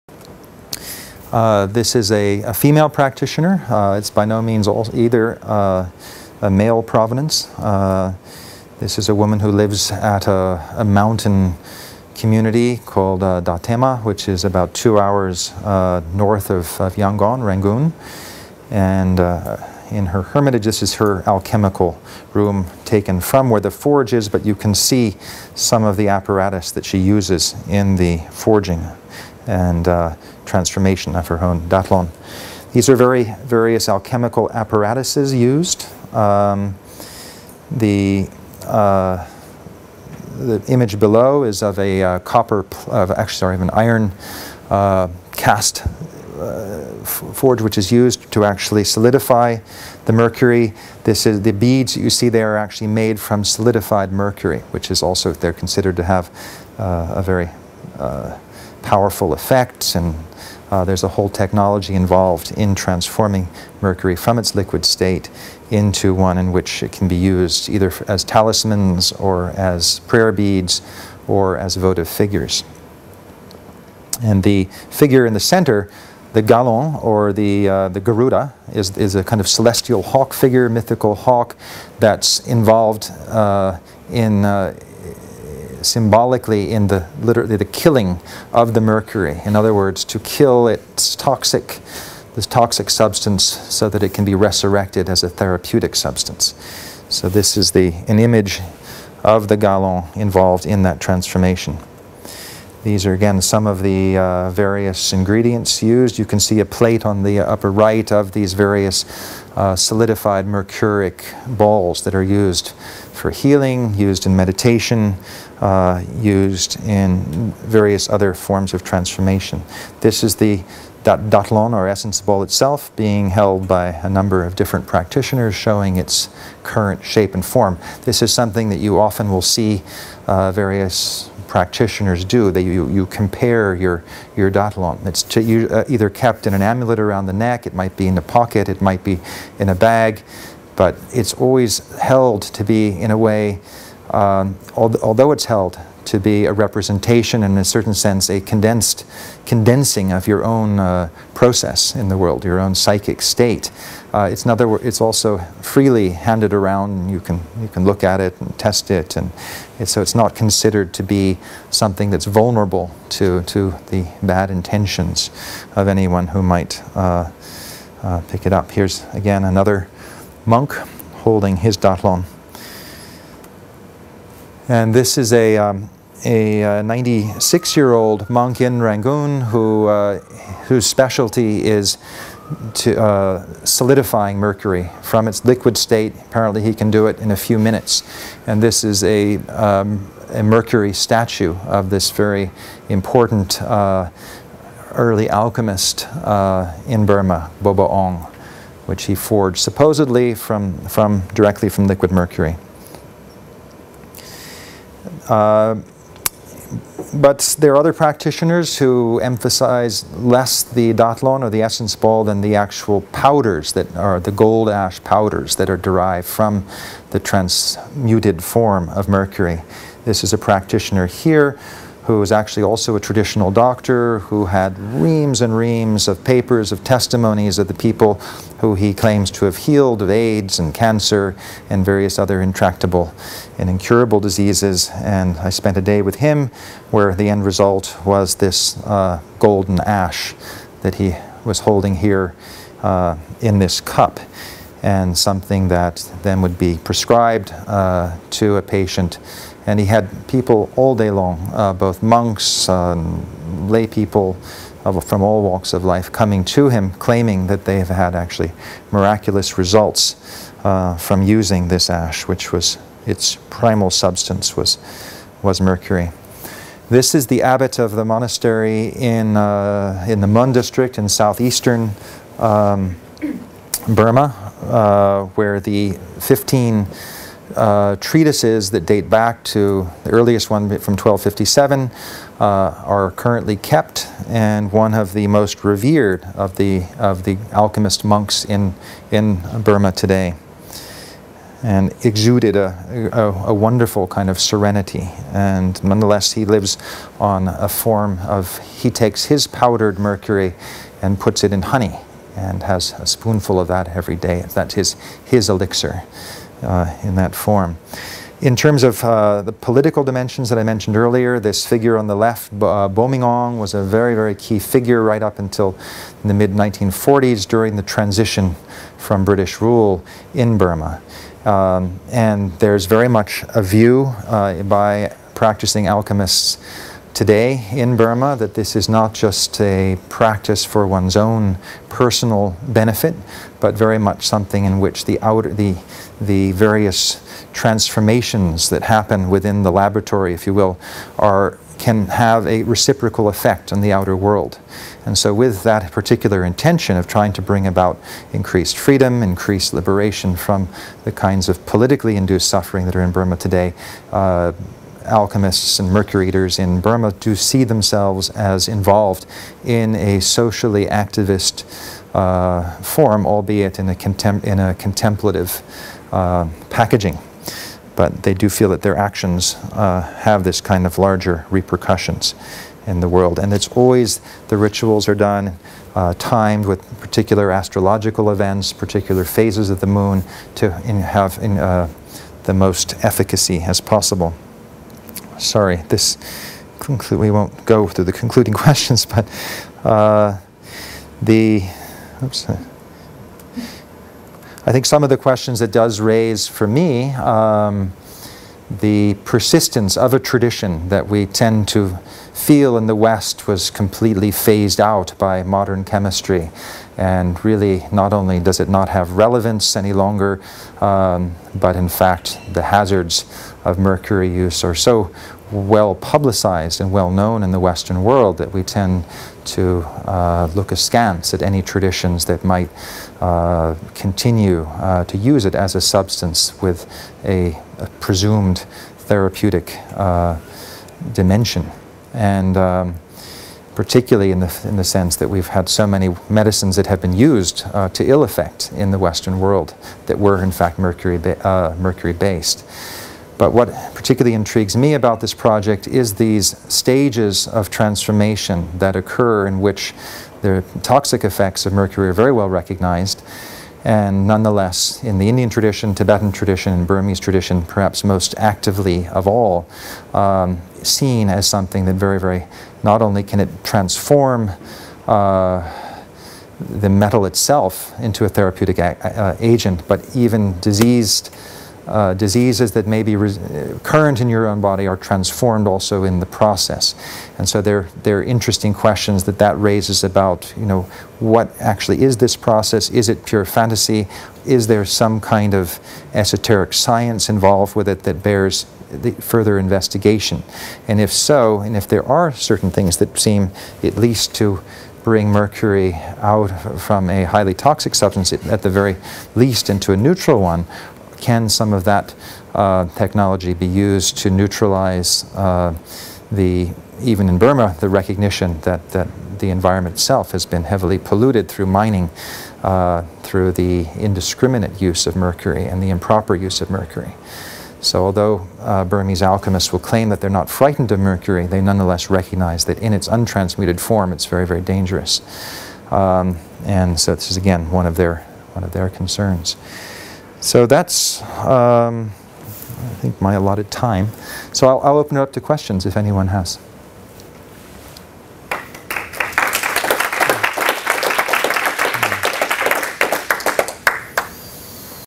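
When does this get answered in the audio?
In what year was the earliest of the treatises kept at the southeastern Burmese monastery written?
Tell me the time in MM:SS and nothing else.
04:40.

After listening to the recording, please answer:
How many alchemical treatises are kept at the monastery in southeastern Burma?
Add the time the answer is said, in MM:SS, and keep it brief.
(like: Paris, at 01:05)
15, at 04:36.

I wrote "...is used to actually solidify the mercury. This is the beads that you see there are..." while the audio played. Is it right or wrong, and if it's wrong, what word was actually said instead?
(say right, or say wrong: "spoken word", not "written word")
right.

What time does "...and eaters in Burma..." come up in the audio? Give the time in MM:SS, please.
05:55.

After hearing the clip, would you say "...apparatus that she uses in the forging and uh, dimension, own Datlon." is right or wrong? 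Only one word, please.
wrong.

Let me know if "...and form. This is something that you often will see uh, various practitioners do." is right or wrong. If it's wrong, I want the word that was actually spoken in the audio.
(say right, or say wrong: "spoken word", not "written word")
right.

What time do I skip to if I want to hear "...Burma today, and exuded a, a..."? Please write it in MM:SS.
04:49.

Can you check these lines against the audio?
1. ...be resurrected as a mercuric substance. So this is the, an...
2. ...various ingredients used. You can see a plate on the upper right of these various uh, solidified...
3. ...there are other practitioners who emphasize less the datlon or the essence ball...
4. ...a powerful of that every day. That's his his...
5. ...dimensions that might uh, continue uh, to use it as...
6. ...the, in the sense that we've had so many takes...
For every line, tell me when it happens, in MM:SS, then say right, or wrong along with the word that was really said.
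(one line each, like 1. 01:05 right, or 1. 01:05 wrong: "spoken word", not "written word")
1. 01:34 wrong: "therapeutic", not "mercuric"
2. 01:44 right
3. 03:27 right
4. 05:02 wrong: "spoonful", not "powerful"
5. 07:01 wrong: "traditions", not "dimensions"
6. 07:14 wrong: "medicines", not "takes".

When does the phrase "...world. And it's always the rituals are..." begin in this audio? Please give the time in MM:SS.
06:13.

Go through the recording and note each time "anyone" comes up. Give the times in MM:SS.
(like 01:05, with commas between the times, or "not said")
02:45, 08:55.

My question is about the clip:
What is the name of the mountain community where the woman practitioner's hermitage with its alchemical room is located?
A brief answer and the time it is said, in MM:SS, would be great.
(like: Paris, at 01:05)
Datema, at 00:13.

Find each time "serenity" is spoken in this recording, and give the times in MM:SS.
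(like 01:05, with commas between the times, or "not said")
04:54.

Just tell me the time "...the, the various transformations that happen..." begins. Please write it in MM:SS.
05:35.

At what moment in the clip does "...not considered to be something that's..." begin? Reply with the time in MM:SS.
02:40.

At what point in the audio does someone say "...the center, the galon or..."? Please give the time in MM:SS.
01:15.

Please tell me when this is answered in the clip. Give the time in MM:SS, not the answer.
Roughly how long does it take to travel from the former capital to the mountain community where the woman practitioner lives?
00:14.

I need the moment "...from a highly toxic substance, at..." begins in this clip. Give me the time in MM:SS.
08:16.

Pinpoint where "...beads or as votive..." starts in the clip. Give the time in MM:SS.
01:10.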